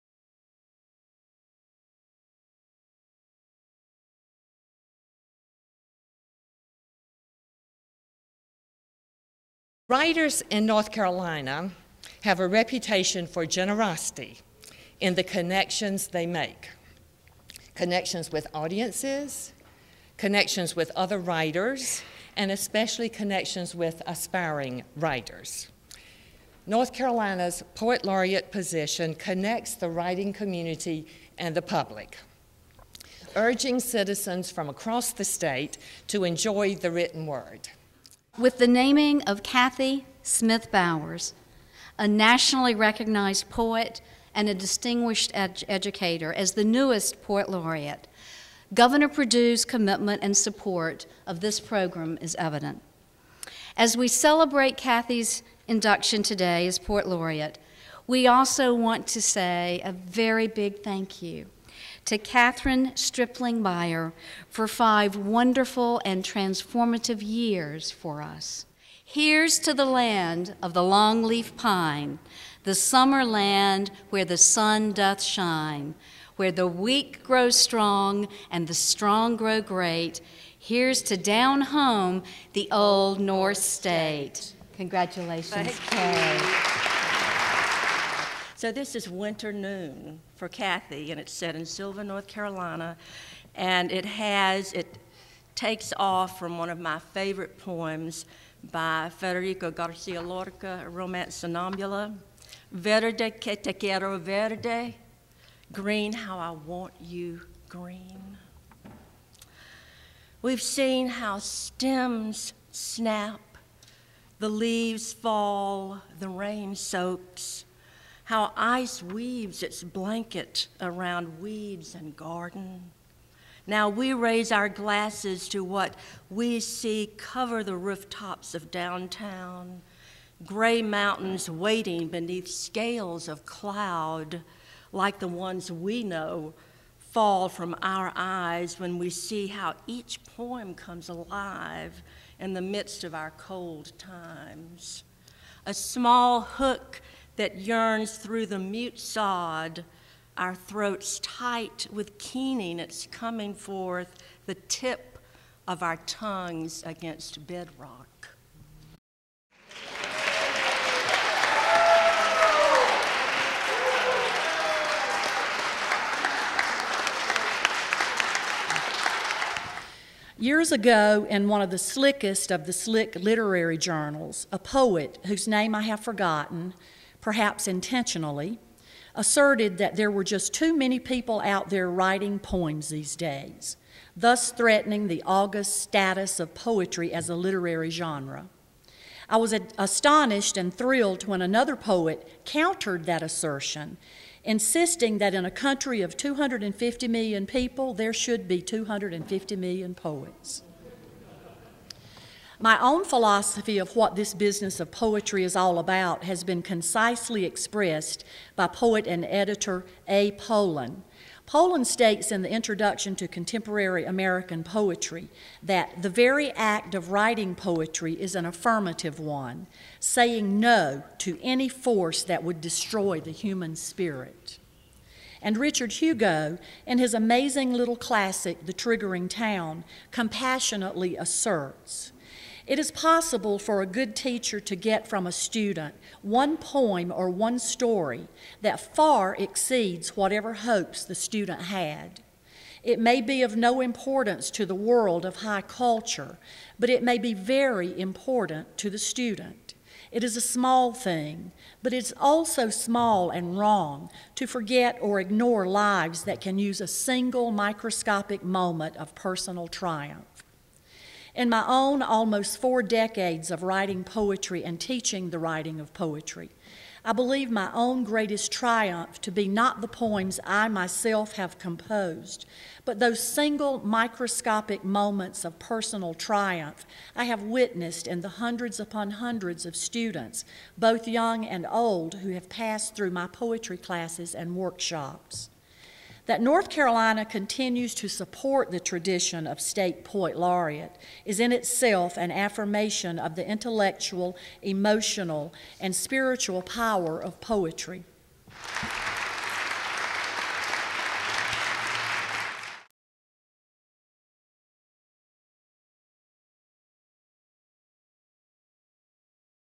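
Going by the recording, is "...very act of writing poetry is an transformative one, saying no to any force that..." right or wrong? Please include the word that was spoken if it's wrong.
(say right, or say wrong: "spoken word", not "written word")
wrong: "affirmative", not "transformative".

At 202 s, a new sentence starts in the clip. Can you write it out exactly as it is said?
My own philosophy of what this business of poetry is all about has been concisely expressed by poet and editor A.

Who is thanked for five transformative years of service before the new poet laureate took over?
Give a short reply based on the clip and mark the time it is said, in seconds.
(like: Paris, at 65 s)
Kathryn Stripling Byer, at 62 s.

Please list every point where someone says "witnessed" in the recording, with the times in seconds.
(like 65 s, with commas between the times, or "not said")
277 s.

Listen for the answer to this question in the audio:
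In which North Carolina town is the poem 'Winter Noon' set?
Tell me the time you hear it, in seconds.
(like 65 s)
91 s.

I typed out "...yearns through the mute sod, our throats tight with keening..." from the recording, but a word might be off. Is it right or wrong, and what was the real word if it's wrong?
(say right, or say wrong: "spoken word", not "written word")
right.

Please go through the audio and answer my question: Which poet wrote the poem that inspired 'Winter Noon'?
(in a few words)
Federico Garcia Lorca.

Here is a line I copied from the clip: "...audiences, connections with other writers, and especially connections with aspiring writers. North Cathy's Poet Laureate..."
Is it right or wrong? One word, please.
wrong.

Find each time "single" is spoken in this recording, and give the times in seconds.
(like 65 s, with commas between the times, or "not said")
256 s, 273 s.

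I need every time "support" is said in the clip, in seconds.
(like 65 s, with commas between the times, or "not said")
50 s, 288 s.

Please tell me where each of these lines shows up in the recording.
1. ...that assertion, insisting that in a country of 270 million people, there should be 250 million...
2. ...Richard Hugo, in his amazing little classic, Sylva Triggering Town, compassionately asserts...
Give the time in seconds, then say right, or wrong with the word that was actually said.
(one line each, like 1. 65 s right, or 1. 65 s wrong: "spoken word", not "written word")
1. 193 s wrong: "250", not "270"
2. 225 s wrong: "The", not "Sylva".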